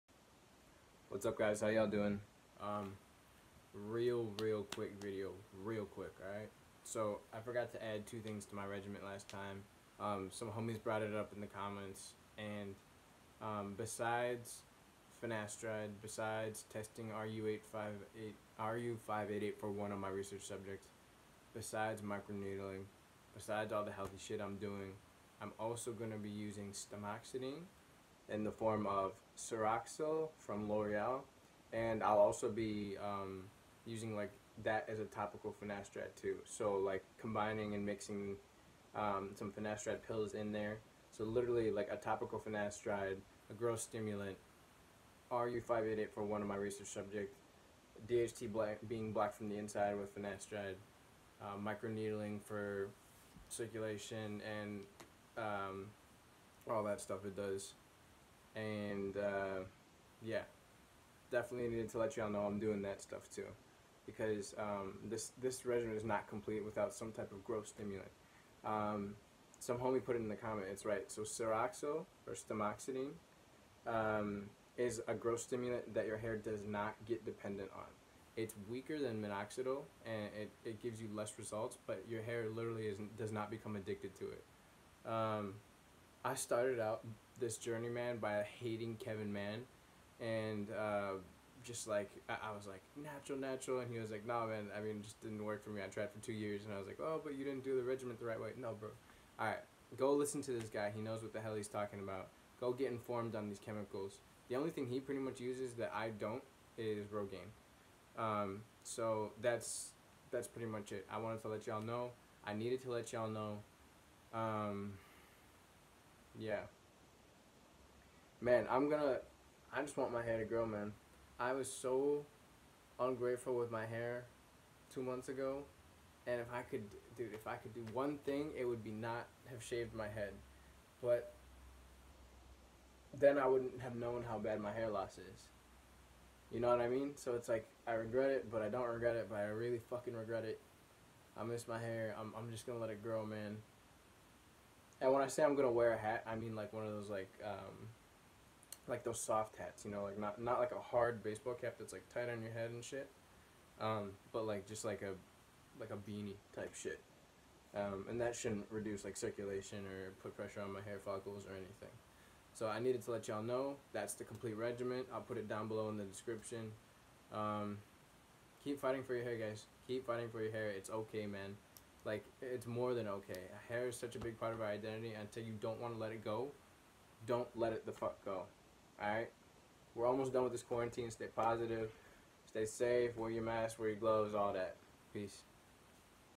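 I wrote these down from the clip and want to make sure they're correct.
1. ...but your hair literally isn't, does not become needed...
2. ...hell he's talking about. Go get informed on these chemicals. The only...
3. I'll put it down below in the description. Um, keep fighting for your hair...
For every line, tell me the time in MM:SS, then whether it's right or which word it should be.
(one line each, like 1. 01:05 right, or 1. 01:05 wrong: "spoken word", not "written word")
1. 01:21 wrong: "addicted", not "needed"
2. 01:41 right
3. 02:45 right.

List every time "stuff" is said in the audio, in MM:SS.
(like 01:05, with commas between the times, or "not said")
00:57, 01:03.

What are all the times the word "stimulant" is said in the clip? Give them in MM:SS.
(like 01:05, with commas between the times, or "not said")
00:43, 01:07, 01:15.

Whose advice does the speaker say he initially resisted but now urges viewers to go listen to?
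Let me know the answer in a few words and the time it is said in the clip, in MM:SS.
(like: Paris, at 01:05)
Kevin Mann, at 01:29.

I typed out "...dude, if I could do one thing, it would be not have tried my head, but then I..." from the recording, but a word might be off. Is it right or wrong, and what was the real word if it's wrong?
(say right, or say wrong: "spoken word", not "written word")
wrong: "shaved", not "tried".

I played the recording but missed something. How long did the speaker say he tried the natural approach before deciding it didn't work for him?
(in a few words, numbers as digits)
2 years.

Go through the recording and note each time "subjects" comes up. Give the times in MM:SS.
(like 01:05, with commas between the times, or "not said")
00:20, 00:46.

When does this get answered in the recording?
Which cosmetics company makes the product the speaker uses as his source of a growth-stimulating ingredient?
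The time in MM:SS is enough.
00:30.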